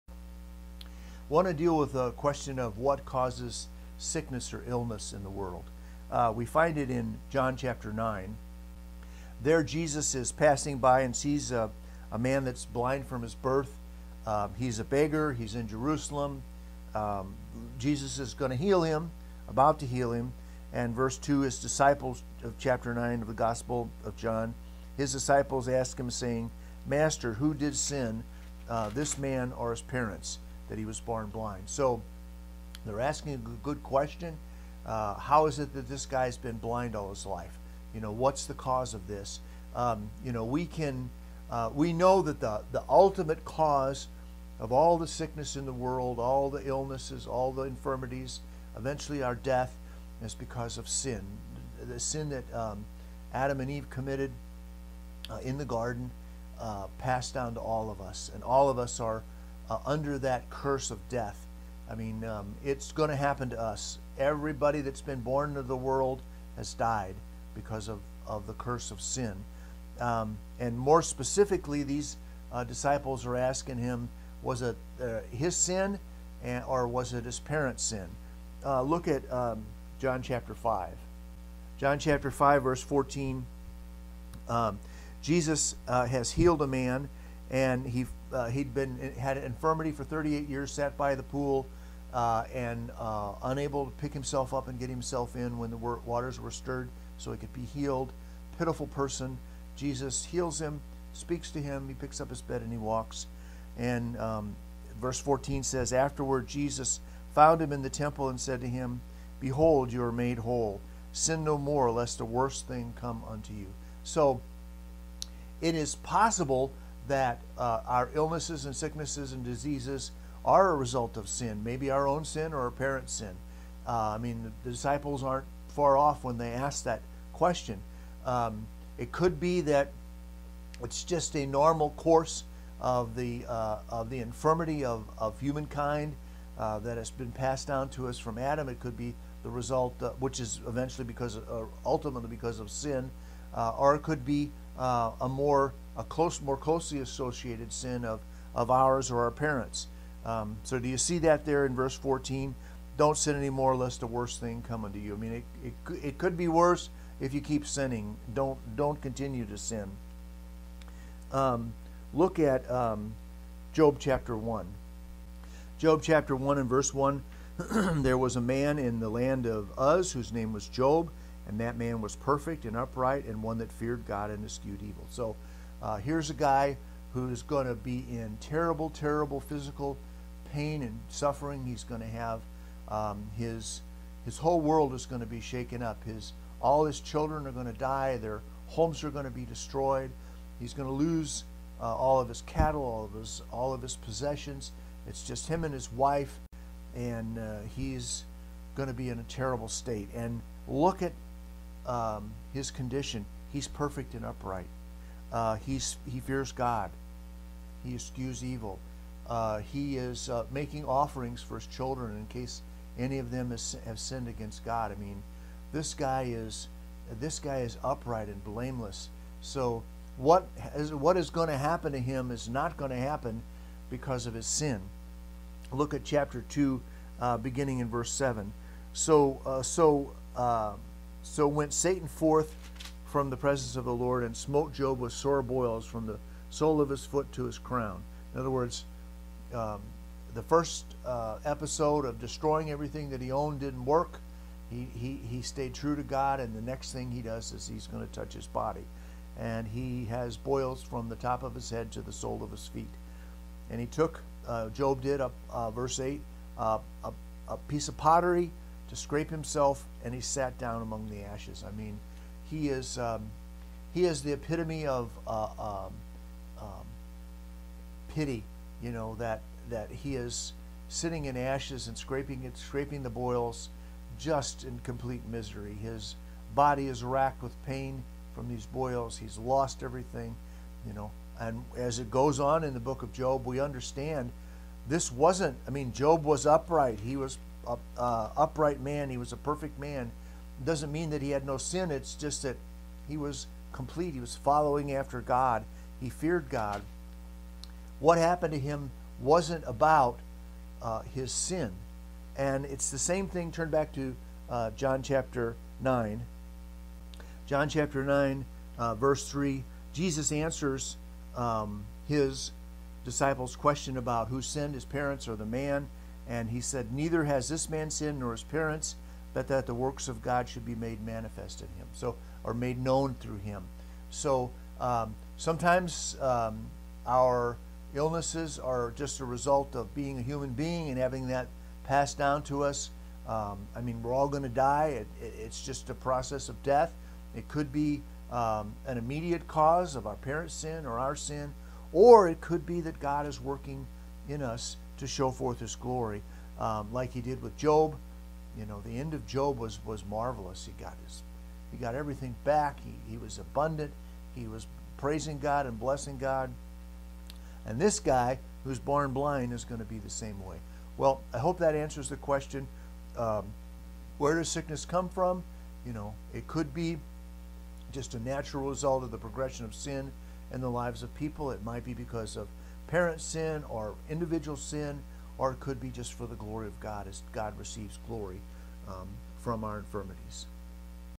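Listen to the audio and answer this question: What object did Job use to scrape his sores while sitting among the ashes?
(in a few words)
A piece of pottery.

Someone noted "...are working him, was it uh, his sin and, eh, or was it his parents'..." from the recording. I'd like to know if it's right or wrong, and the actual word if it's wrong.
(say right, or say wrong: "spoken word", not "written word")
wrong: "asking", not "working".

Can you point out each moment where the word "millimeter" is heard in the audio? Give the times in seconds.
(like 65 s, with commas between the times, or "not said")
not said.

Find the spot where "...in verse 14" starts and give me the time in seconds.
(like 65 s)
151 s.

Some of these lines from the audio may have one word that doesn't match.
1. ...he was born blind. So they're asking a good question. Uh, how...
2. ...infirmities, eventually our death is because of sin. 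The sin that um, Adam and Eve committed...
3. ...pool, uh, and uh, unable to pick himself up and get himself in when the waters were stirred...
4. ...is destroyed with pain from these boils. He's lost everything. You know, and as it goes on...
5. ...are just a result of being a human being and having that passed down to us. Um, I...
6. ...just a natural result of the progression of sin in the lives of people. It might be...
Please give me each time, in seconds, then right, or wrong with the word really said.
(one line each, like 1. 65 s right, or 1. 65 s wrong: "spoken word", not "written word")
1. 30 s right
2. 47 s right
3. 91 s right
4. 276 s wrong: "racked", not "destroyed"
5. 328 s right
6. 367 s right.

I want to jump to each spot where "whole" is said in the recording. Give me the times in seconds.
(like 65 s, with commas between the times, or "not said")
110 s, 184 s.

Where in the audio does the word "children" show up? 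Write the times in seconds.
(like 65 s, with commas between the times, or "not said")
186 s, 211 s.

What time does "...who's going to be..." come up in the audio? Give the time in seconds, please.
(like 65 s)
177 s.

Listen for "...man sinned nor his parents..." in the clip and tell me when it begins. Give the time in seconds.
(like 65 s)
317 s.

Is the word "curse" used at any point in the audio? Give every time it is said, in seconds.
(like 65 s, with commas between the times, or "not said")
60 s, 68 s.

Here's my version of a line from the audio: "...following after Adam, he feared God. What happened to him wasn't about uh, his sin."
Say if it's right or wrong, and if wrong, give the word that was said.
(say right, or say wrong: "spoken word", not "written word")
wrong: "God", not "Adam".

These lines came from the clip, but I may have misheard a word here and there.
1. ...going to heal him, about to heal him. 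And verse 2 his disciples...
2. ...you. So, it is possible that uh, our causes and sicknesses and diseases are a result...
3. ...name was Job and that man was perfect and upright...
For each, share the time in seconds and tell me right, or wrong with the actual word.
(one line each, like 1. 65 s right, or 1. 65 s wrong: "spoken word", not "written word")
1. 18 s right
2. 113 s wrong: "illnesses", not "causes"
3. 170 s right.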